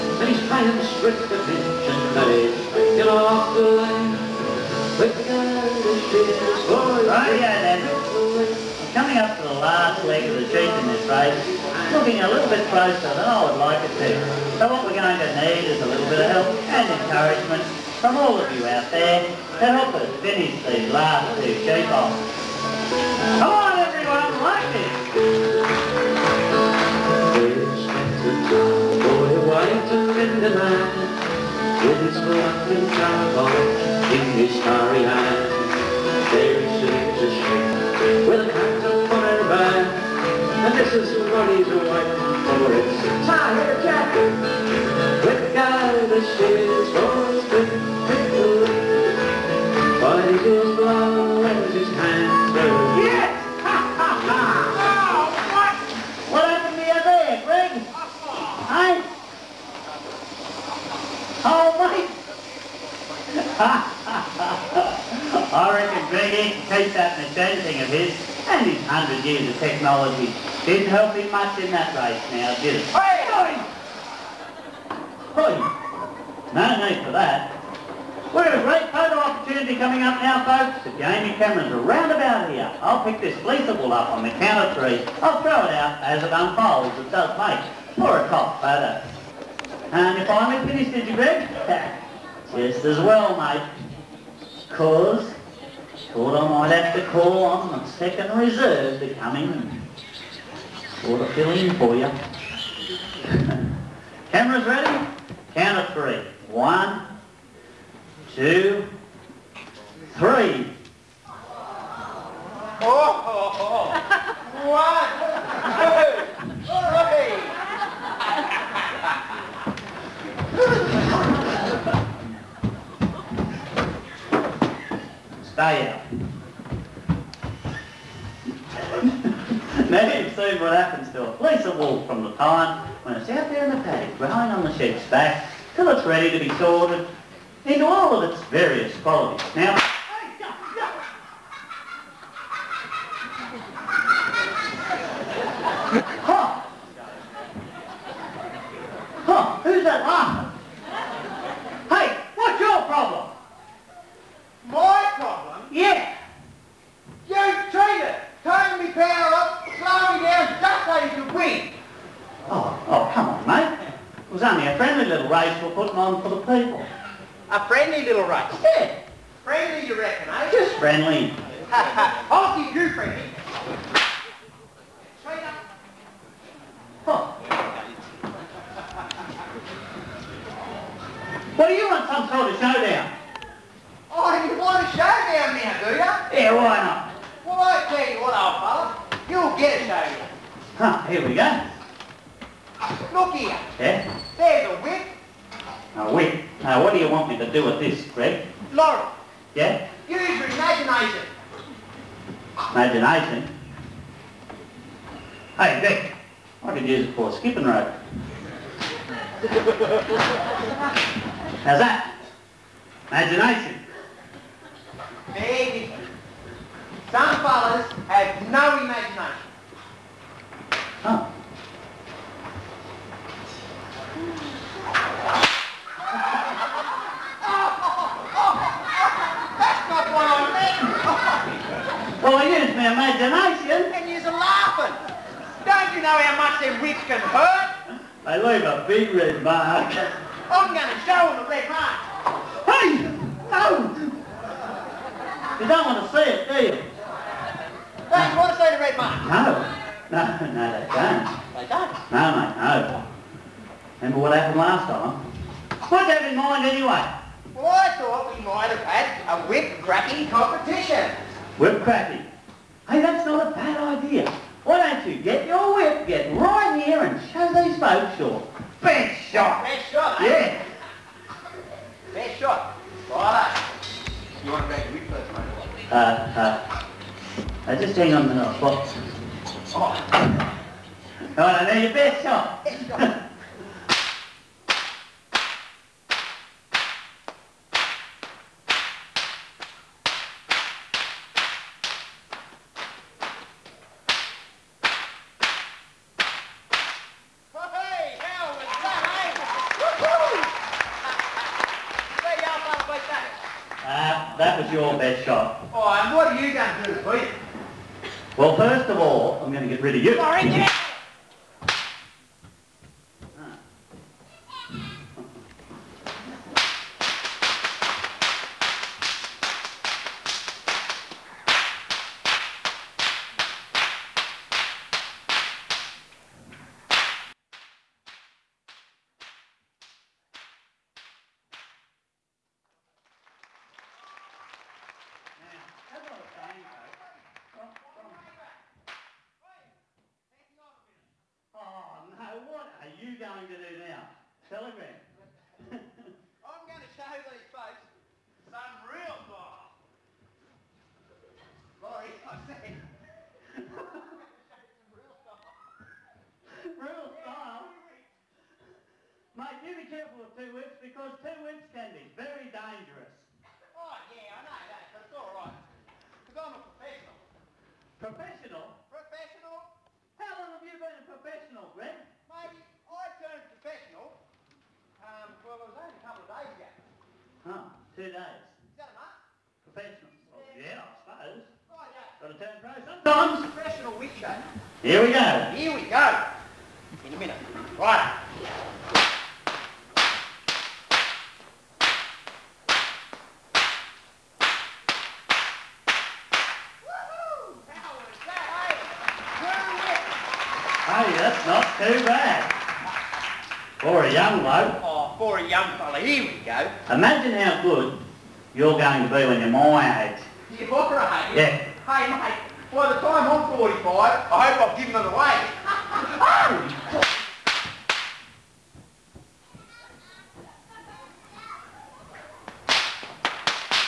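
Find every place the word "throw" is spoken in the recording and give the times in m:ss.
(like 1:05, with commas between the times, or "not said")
1:25.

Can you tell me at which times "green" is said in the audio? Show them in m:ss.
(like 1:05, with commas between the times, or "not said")
not said.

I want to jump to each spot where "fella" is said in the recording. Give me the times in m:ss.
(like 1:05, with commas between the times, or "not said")
3:08, 3:37, 6:45.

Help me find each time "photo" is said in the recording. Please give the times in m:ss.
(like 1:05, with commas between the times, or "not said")
1:18, 1:28.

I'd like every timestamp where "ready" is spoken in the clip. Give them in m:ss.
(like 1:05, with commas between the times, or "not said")
1:44, 2:16.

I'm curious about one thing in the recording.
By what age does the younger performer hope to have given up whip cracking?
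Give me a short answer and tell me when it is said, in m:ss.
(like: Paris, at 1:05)
45, at 6:53.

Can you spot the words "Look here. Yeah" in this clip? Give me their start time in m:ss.
3:13.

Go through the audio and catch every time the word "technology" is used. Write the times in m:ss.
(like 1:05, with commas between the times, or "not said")
1:09.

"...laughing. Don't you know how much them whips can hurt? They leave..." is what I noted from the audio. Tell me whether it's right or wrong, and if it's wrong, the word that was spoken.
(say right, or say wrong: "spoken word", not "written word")
right.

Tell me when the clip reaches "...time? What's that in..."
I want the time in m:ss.
4:14.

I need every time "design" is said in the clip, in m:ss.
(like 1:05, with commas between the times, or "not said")
not said.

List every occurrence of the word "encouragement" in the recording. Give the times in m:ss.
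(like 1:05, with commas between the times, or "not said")
0:17.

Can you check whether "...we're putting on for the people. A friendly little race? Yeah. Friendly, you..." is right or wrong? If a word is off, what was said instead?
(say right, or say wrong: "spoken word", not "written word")
right.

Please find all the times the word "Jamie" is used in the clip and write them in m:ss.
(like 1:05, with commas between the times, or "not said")
1:20.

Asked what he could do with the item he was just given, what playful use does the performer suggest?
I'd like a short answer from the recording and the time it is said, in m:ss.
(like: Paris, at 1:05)
A skipping rope, at 3:27.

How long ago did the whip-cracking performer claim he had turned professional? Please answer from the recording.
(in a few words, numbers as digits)
A couple of days.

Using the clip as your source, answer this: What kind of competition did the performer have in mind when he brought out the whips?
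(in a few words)
Whip cracking competition.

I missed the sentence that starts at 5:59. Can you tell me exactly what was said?
Mate, you be careful with two whips because two whips can be very dangerous.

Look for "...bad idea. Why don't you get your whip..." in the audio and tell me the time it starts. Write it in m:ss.
4:23.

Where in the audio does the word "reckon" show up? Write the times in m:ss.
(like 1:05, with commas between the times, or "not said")
1:05, 2:49.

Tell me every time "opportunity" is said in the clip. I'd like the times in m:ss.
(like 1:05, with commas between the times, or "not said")
1:19.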